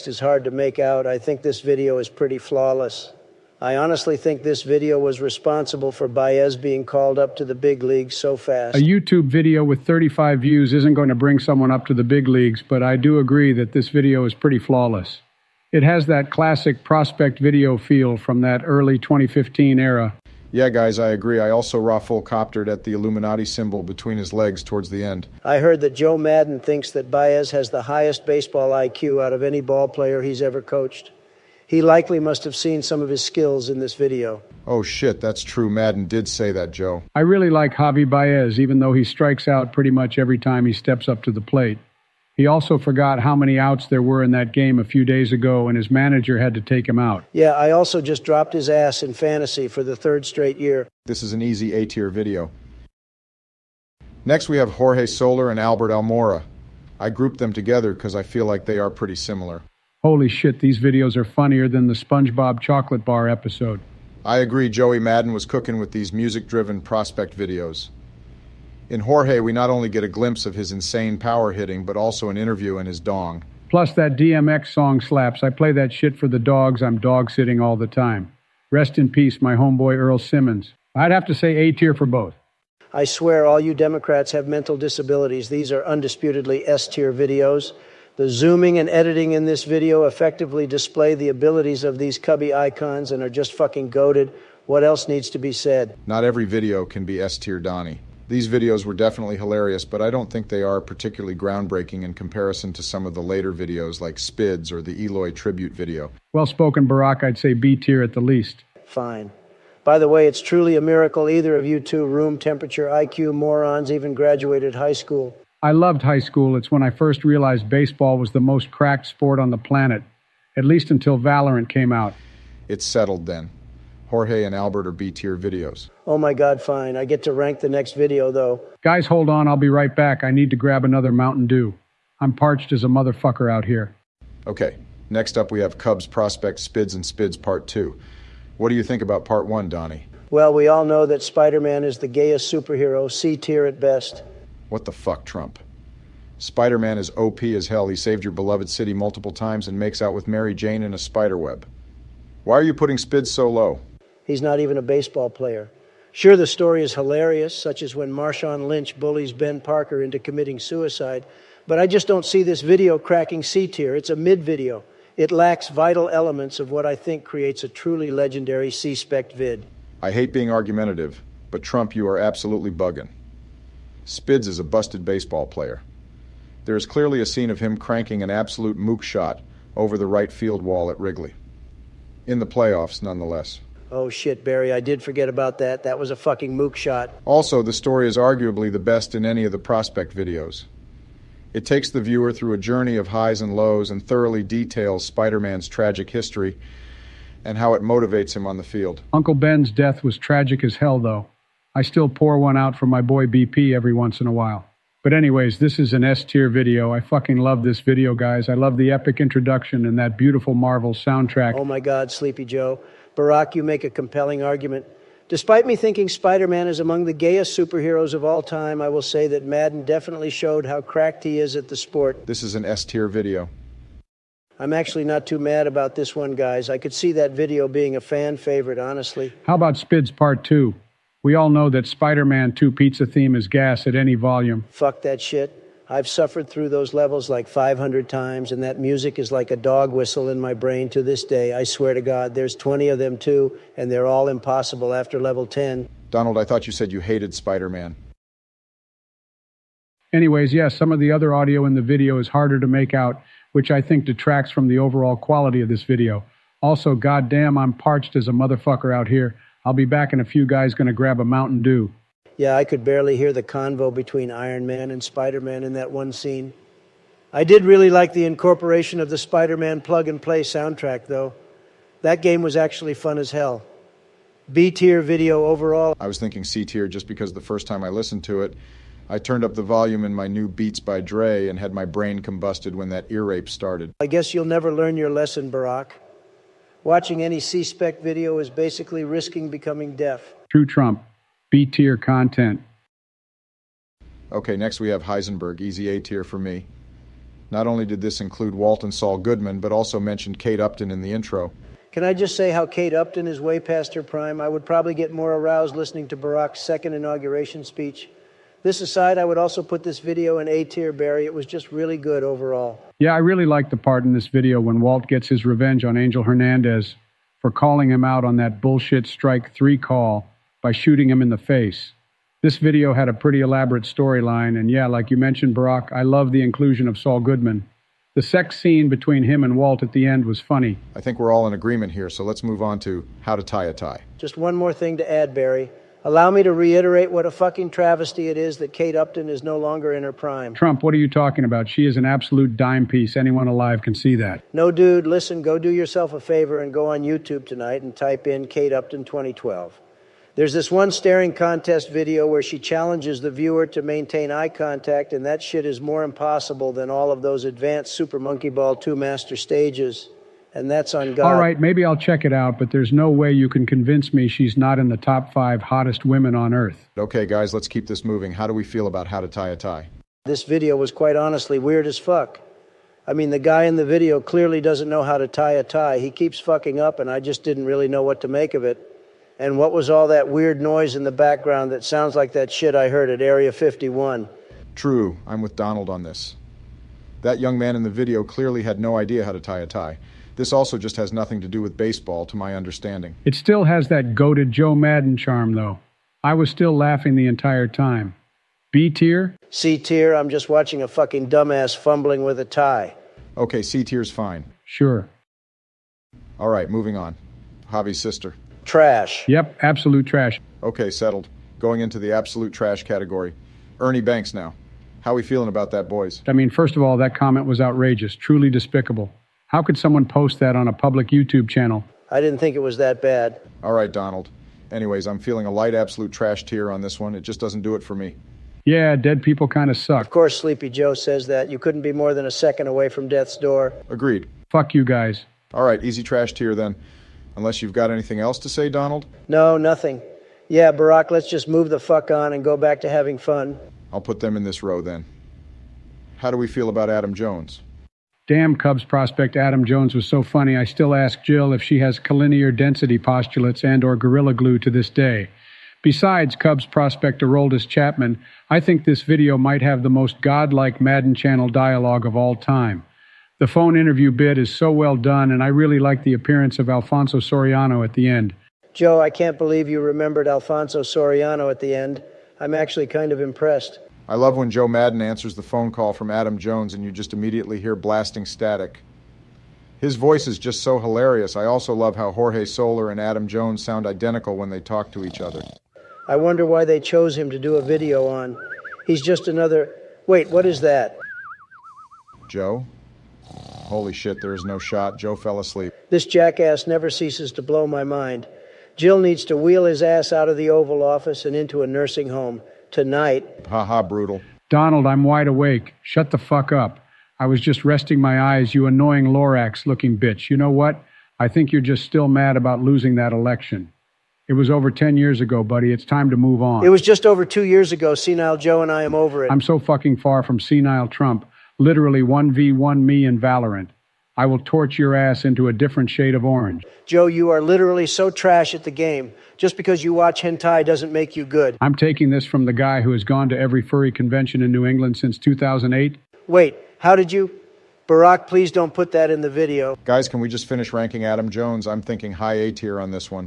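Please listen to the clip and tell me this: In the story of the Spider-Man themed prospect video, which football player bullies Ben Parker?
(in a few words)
Marshawn Lynch.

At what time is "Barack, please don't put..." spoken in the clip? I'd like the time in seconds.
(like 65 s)
537 s.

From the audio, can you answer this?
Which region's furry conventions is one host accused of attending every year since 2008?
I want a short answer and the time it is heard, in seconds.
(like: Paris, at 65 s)
New England, at 534 s.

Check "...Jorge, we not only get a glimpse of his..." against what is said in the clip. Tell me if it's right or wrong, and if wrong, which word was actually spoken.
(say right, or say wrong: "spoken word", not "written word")
right.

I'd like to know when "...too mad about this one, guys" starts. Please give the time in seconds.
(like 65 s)
225 s.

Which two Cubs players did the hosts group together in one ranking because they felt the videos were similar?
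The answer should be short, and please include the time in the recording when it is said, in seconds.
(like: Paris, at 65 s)
Jorge Soler and Albert Almora, at 54 s.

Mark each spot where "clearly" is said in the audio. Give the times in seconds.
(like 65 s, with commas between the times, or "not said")
176 s, 374 s, 388 s.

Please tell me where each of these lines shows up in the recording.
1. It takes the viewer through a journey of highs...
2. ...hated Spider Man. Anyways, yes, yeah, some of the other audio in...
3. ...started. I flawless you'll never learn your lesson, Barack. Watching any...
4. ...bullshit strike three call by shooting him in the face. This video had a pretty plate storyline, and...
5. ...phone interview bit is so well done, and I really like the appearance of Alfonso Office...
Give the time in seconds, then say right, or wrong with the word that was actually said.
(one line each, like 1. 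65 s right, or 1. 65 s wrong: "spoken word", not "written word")
1. 191 s right
2. 246 s right
3. 283 s wrong: "guess", not "flawless"
4. 318 s wrong: "elaborate", not "plate"
5. 463 s wrong: "Soriano", not "Office".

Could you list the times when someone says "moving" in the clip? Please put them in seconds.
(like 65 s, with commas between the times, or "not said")
368 s, 406 s.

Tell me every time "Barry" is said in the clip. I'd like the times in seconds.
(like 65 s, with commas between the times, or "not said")
184 s, 310 s, 335 s.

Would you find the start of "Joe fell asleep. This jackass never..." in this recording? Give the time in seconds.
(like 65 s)
494 s.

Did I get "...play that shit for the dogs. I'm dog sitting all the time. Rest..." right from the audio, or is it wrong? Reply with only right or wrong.
right.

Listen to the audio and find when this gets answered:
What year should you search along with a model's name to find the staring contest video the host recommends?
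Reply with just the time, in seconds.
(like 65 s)
348 s.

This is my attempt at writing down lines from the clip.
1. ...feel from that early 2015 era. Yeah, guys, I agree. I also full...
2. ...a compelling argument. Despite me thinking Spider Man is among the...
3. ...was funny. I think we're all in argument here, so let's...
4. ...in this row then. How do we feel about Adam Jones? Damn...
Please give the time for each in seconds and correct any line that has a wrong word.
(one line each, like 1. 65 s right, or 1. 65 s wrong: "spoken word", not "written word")
1. 17 s right
2. 213 s right
3. 330 s wrong: "agreement", not "argument"
4. 444 s right.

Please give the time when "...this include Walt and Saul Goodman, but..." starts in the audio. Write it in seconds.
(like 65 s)
297 s.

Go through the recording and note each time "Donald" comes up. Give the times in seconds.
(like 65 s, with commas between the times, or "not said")
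246 s, 385 s, 423 s, 438 s, 504 s.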